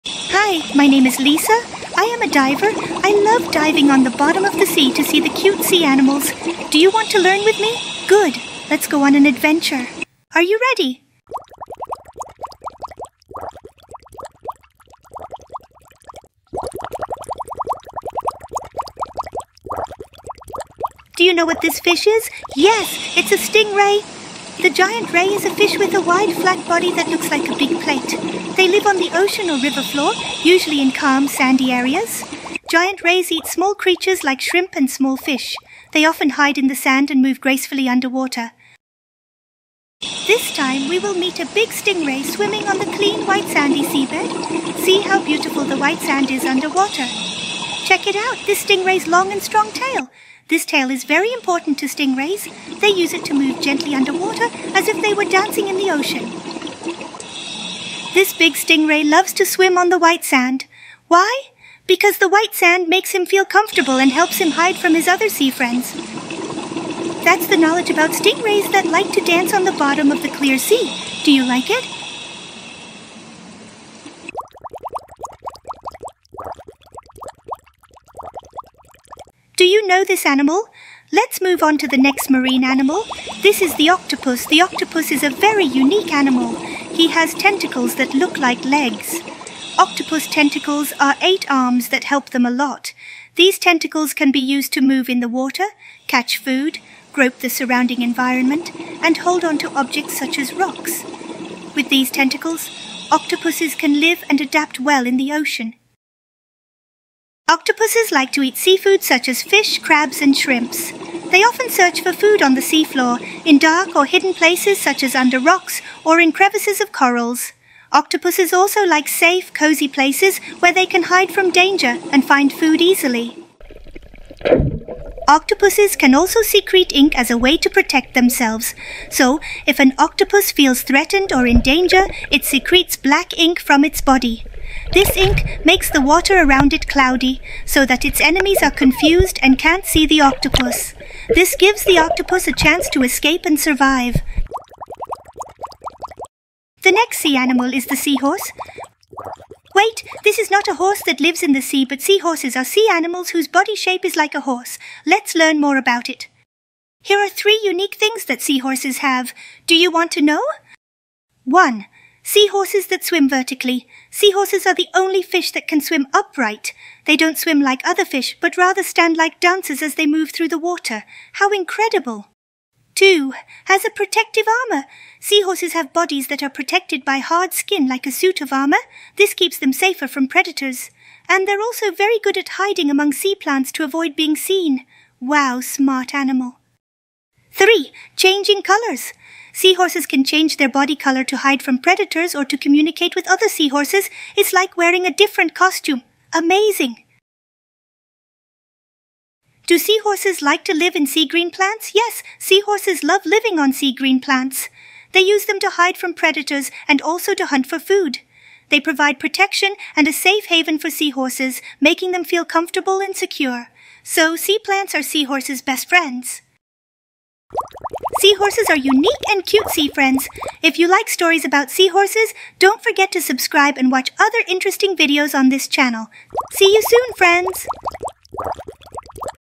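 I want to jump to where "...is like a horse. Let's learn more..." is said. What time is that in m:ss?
2:34.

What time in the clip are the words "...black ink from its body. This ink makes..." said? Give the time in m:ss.
2:12.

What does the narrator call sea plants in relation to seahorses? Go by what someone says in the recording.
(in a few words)
Best friends.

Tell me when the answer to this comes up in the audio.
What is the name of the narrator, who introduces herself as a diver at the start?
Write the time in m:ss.
0:01.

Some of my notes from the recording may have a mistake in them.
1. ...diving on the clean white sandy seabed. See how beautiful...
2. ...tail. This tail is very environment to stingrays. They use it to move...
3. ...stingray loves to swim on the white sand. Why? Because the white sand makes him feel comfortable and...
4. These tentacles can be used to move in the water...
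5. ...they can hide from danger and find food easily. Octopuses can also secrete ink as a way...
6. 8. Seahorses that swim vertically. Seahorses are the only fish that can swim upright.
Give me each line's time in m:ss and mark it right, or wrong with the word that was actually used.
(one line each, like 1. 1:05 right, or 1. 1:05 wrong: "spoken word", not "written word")
1. 0:42 wrong: "swimming", not "diving"
2. 0:49 wrong: "important", not "environment"
3. 0:58 right
4. 1:33 right
5. 2:00 right
6. 2:41 wrong: "1", not "8".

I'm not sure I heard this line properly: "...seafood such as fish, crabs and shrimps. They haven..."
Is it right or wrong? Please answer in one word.
wrong.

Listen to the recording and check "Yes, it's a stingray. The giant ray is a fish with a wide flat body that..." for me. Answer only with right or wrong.
right.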